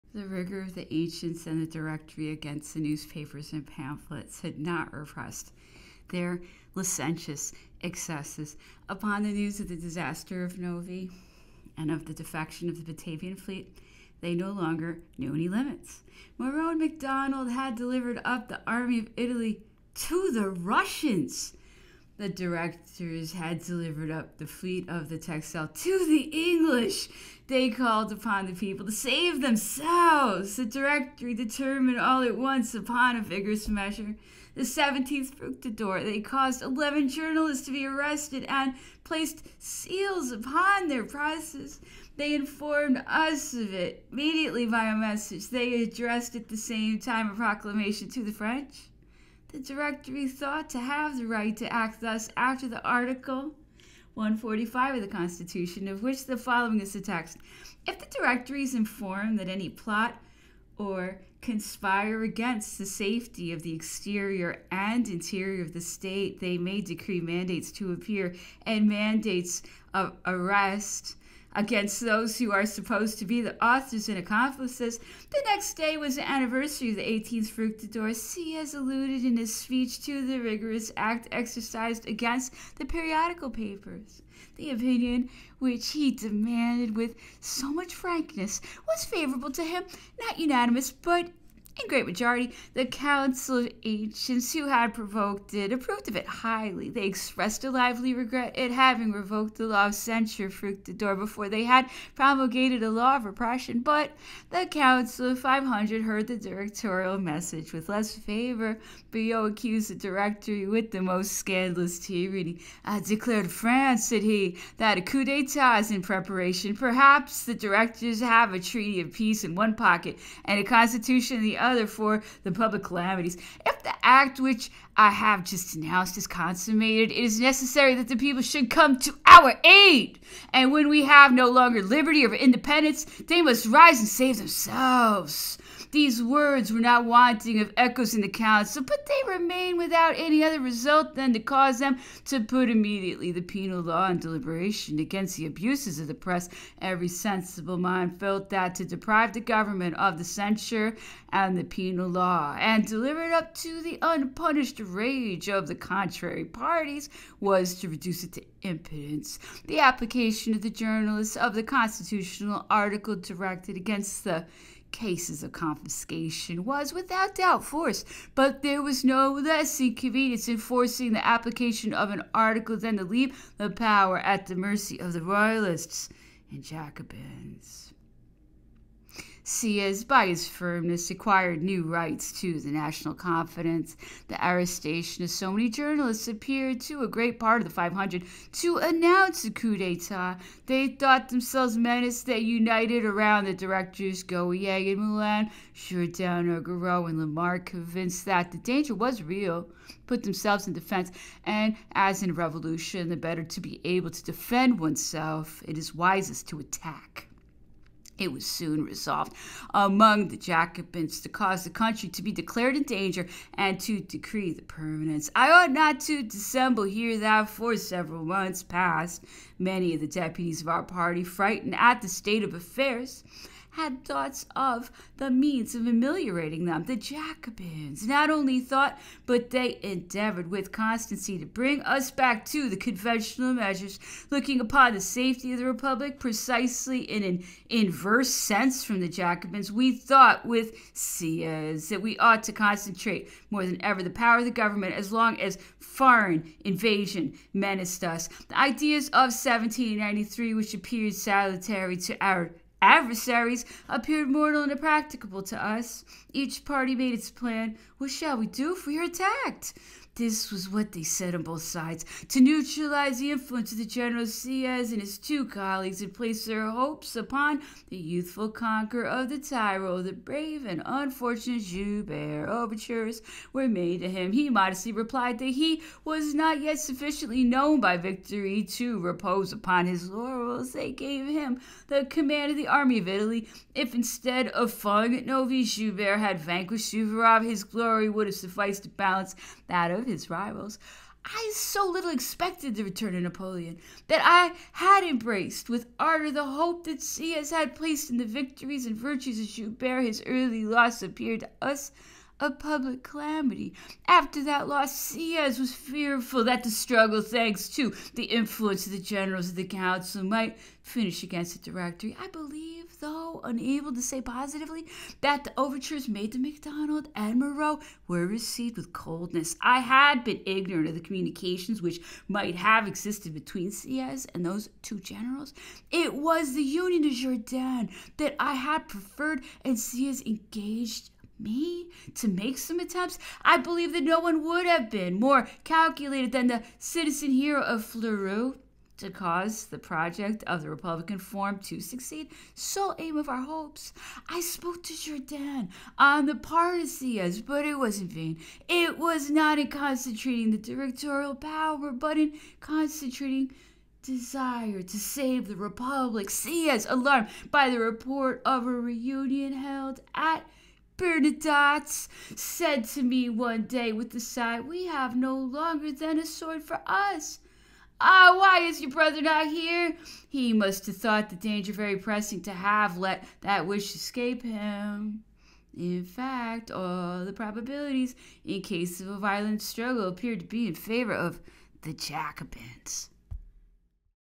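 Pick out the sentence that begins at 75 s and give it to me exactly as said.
The next day was the anniversary of the 18th Fructidor.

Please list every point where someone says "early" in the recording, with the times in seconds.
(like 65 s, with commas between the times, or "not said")
300 s.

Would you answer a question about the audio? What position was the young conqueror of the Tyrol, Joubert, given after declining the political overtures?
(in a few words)
command of the army of Italy.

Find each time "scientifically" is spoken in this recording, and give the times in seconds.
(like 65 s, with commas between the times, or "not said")
not said.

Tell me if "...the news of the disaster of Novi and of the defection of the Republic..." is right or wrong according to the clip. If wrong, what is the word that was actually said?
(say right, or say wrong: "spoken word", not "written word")
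wrong: "Batavian", not "Republic".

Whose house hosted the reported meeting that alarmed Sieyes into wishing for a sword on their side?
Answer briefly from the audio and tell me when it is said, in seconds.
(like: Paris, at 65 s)
Bernadotte, at 360 s.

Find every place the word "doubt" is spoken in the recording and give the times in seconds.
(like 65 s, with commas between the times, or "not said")
167 s.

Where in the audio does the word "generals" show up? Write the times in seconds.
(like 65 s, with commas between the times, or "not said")
263 s, 308 s, 324 s.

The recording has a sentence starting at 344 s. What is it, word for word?
I spoke to Jourdan on the Parisias, but it was in vain.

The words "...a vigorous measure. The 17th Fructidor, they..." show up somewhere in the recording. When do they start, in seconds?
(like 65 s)
33 s.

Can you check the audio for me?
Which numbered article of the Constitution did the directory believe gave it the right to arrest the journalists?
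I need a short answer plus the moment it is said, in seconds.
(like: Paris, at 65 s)
Article 145, at 52 s.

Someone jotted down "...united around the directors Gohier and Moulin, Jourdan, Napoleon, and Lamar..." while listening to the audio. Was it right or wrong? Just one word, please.
wrong.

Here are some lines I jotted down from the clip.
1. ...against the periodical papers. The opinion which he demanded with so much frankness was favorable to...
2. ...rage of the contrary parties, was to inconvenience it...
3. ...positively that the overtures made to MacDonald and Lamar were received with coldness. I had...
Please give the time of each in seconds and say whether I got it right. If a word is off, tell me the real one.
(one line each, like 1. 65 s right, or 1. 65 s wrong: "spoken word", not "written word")
1. 82 s right
2. 154 s wrong: "reduce", not "inconvenience"
3. 314 s wrong: "Moreau", not "Lamar".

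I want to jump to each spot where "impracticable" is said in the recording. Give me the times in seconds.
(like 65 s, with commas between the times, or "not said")
254 s.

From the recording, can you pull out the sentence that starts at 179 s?
Sieyes, by his firmness, acquired new rights to the national confidence.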